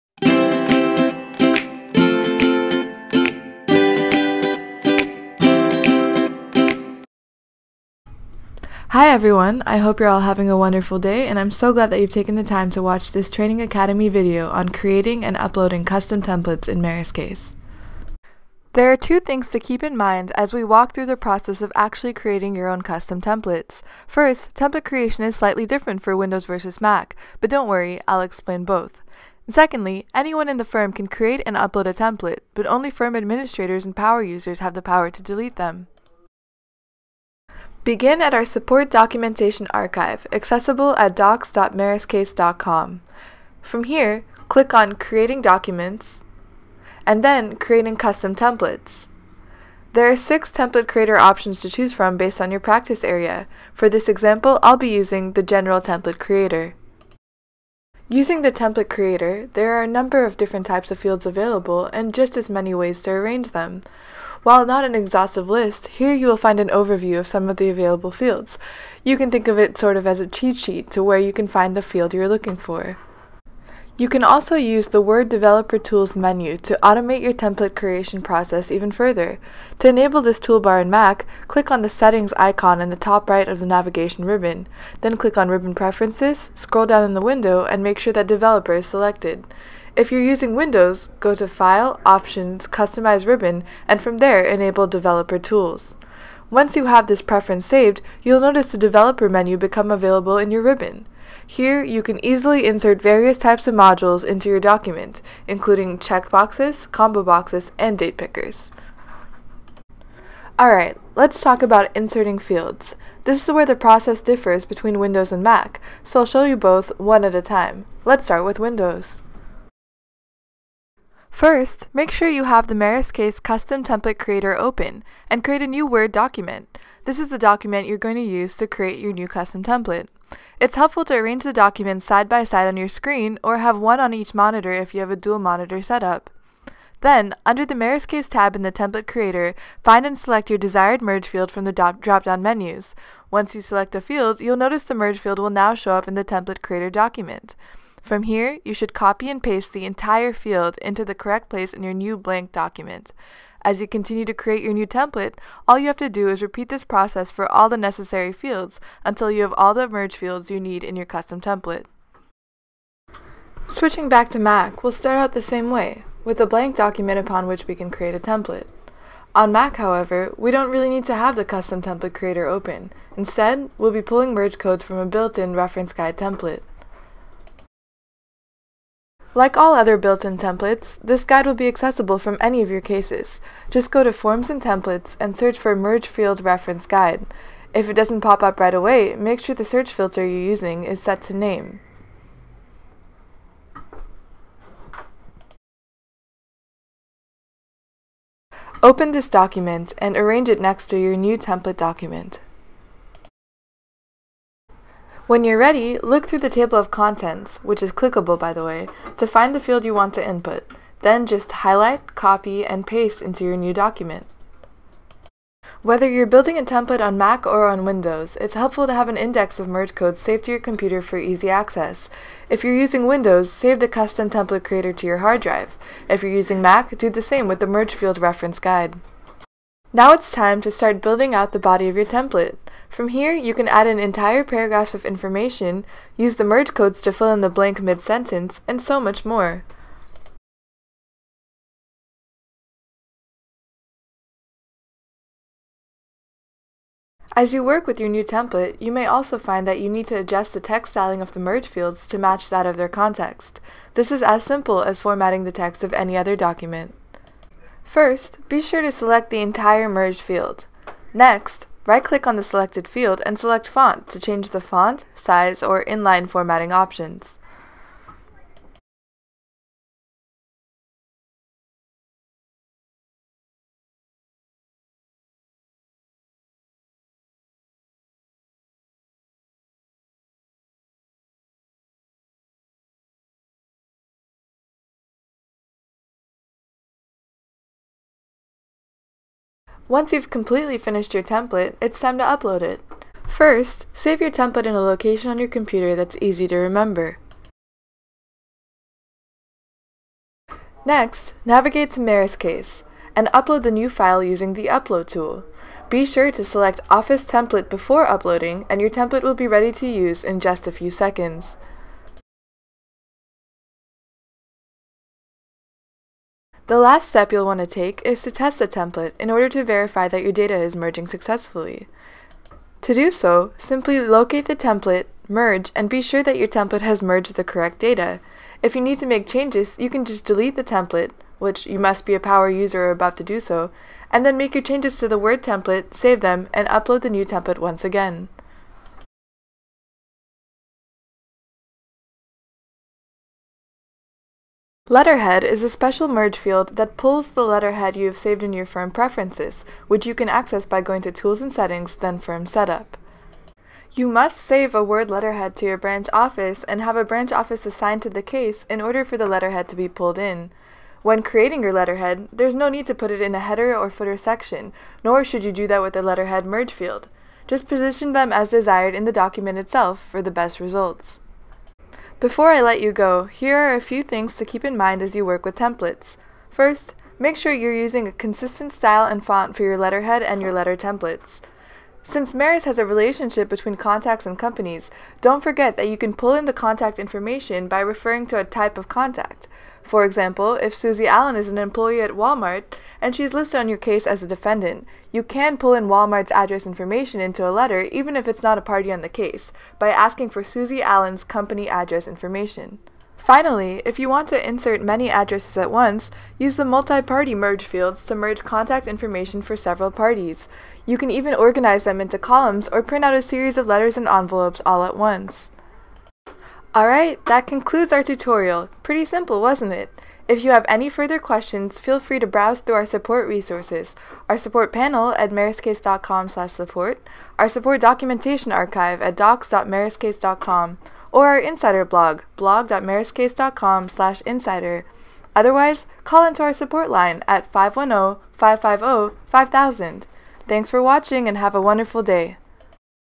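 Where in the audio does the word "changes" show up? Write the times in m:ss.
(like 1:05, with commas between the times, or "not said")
4:24, 5:29, 5:34.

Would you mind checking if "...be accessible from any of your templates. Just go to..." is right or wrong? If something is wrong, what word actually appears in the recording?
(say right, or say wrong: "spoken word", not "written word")
wrong: "cases", not "templates".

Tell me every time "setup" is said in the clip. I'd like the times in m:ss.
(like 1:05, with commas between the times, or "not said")
2:15, 5:52.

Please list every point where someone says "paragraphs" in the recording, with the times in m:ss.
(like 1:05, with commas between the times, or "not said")
3:54.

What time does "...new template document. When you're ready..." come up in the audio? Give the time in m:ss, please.
3:21.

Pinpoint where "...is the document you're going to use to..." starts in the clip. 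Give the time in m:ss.
2:07.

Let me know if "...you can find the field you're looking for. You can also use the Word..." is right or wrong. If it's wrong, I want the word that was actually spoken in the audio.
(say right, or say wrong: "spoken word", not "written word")
right.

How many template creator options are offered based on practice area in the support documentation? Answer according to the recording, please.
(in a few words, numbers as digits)
6.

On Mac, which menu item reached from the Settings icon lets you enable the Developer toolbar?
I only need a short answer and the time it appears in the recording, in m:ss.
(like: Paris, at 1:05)
Ribbon Preferences, at 1:25.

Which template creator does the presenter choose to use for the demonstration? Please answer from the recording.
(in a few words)
General Template Creator.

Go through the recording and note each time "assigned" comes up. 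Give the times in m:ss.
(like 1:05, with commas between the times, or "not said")
5:57.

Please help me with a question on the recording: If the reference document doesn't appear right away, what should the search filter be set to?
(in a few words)
Name.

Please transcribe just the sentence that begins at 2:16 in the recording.
Then, under the MerusCase tab in the Template Creator, find and select your desired merge field from the drop-down menus.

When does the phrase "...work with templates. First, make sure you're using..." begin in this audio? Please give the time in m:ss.
6:15.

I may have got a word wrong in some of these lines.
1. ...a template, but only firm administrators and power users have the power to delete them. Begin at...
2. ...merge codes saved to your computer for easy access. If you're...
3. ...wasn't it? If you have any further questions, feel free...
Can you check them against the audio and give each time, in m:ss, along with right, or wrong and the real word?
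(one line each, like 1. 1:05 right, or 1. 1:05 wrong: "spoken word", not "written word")
1. 0:31 right
2. 3:39 right
3. 6:59 right.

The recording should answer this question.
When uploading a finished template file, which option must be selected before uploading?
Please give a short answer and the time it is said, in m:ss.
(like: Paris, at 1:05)
Office Template, at 5:06.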